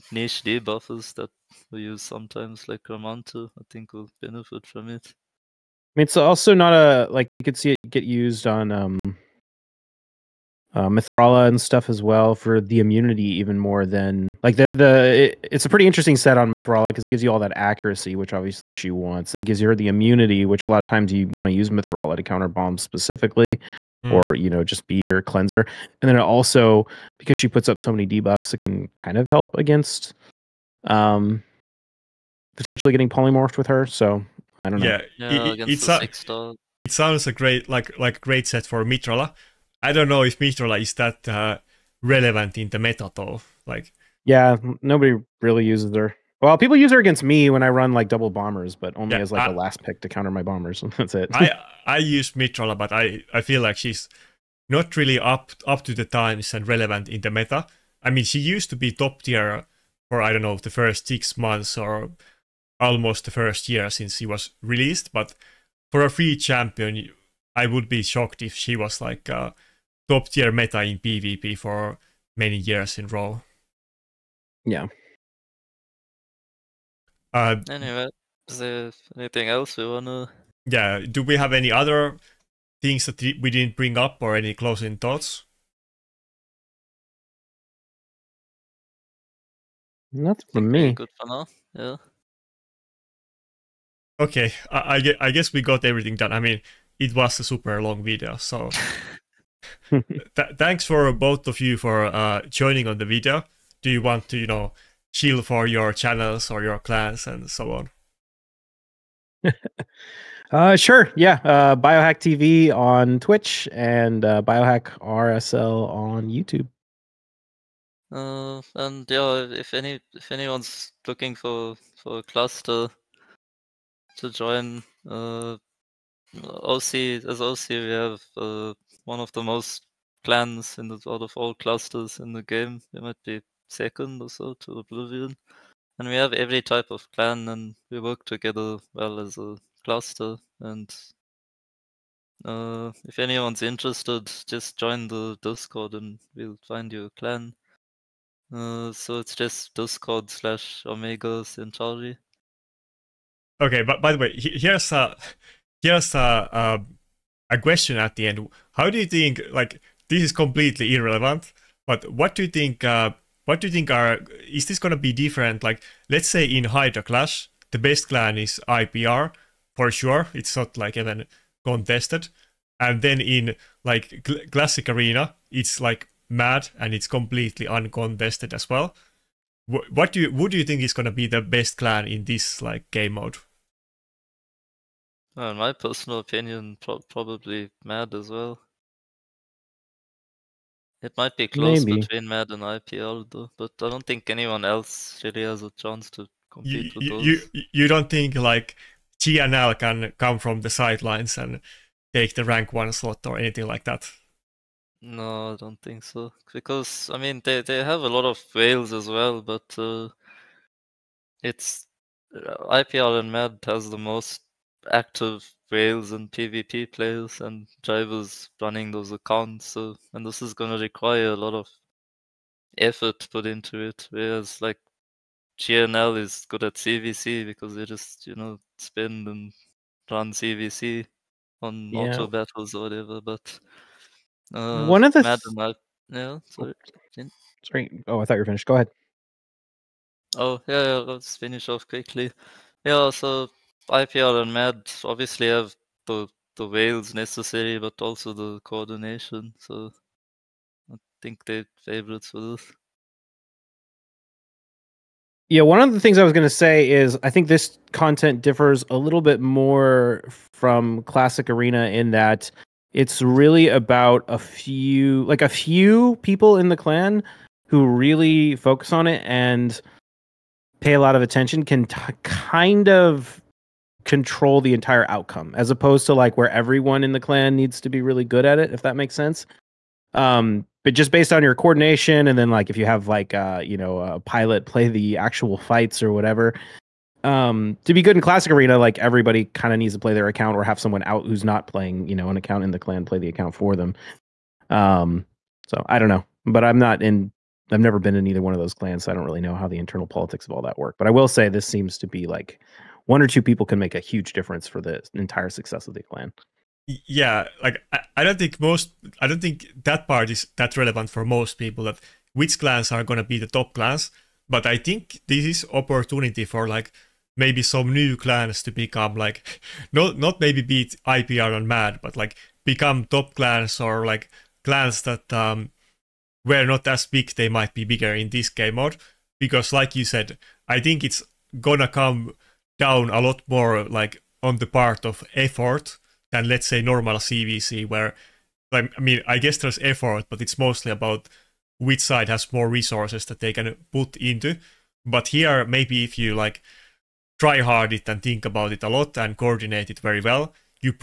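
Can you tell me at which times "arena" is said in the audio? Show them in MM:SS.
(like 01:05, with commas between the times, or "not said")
02:54, 04:21, 04:48.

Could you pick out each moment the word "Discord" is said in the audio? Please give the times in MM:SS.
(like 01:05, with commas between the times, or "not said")
02:25, 02:29.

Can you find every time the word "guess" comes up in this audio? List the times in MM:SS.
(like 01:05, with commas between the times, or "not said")
01:35, 05:39.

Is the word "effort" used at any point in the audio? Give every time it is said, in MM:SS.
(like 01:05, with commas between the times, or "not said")
03:42, 05:35, 05:39.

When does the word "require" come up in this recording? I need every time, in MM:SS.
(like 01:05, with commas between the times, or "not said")
03:40.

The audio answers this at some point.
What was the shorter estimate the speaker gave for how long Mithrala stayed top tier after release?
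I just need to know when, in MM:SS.
01:01.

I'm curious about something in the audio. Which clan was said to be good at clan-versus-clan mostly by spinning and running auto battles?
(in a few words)
GNL.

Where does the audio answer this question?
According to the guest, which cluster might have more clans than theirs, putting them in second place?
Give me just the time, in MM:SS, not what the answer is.
02:14.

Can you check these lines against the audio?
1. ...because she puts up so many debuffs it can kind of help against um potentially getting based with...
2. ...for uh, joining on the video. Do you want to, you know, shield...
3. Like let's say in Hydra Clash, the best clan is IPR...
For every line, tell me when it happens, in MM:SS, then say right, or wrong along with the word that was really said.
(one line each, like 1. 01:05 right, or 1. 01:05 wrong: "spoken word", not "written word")
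1. 00:27 wrong: "polymorphed", not "based"
2. 01:41 right
3. 02:45 right.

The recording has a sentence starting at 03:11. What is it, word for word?
between mad and ipl though but i don't think anyone else really has a chance to compete you, with you, those.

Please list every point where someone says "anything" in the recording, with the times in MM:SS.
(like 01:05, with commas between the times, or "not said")
01:19, 03:23.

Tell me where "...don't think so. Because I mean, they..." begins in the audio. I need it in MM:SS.
03:25.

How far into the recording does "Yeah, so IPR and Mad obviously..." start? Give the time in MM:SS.
04:02.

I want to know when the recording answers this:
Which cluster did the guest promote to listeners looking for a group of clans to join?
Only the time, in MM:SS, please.
02:30.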